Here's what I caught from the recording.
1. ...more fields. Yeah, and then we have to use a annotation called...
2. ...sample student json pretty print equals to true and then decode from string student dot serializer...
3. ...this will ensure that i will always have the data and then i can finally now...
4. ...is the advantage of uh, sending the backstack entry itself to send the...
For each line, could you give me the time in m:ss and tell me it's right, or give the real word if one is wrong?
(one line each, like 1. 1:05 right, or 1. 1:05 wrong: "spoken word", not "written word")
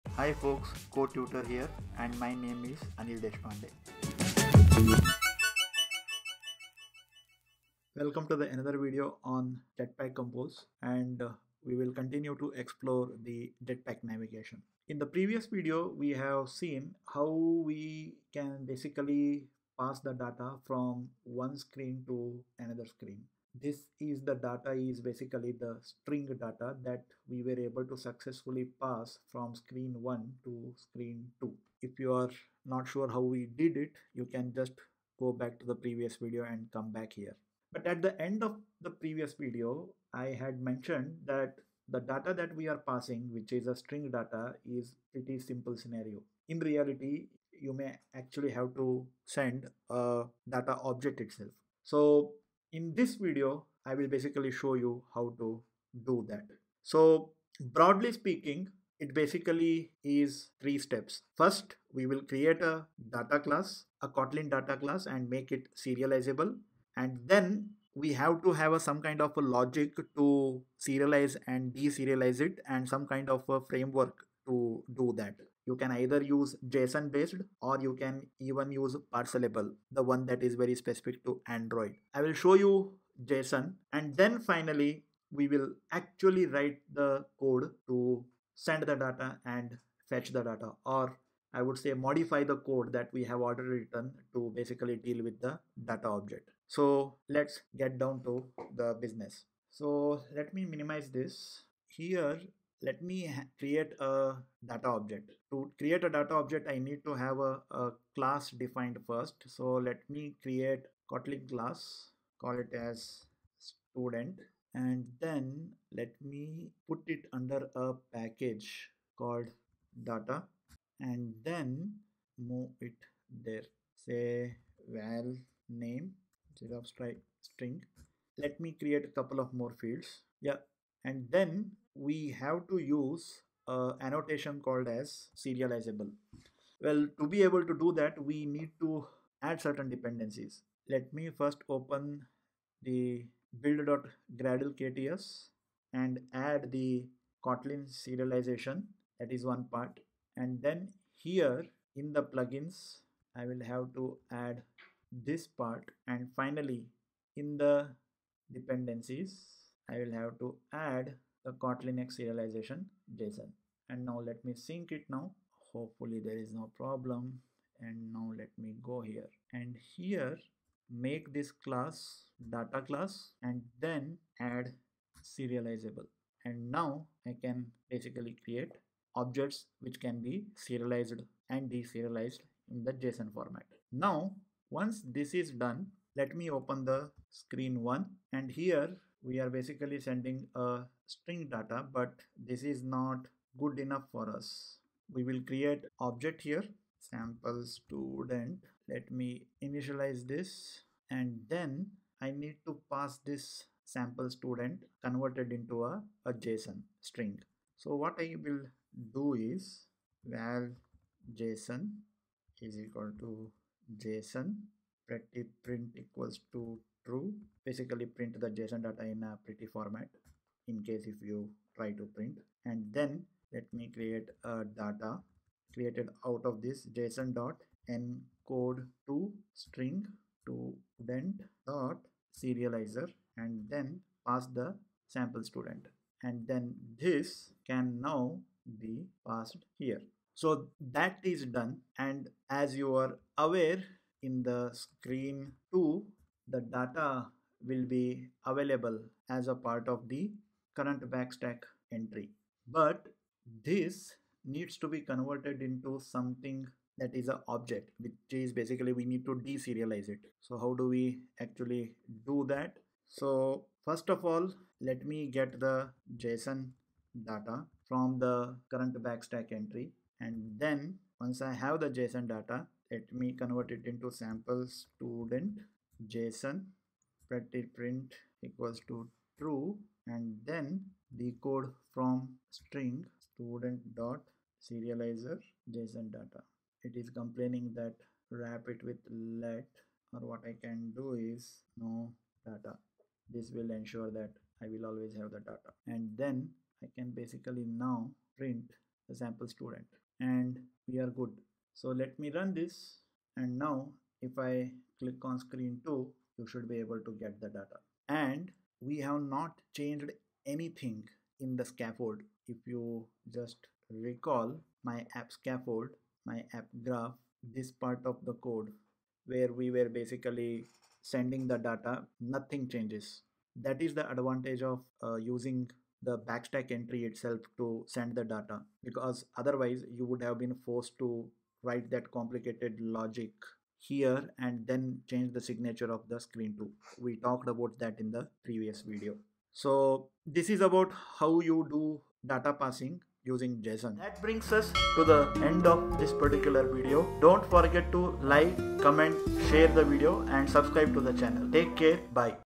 1. 2:09 right
2. 4:34 right
3. 4:53 wrong: "basically", not "finally"
4. 5:23 wrong: "using", not "sending".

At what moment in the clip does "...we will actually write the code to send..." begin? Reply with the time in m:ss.
1:25.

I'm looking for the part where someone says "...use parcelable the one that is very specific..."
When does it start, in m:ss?
1:18.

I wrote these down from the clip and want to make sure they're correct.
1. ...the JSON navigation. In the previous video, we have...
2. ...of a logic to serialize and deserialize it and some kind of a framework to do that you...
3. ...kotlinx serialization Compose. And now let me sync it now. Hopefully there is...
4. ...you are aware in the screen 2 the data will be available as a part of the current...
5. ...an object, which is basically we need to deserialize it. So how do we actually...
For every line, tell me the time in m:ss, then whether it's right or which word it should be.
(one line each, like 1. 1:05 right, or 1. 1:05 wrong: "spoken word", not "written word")
1. 0:13 wrong: "Jetpack", not "JSON"
2. 1:09 right
3. 2:41 wrong: "JSON", not "Compose"
4. 4:02 right
5. 4:17 right.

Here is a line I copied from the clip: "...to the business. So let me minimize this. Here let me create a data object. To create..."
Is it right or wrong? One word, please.
right.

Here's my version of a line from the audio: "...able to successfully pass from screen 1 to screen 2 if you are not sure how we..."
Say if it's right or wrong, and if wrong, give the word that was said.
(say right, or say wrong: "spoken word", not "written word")
right.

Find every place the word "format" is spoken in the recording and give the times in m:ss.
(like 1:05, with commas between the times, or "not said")
3:03, 3:39.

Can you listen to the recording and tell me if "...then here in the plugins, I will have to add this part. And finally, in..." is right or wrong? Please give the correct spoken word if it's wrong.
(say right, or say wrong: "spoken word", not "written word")
right.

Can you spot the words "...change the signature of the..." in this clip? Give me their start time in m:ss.
5:35.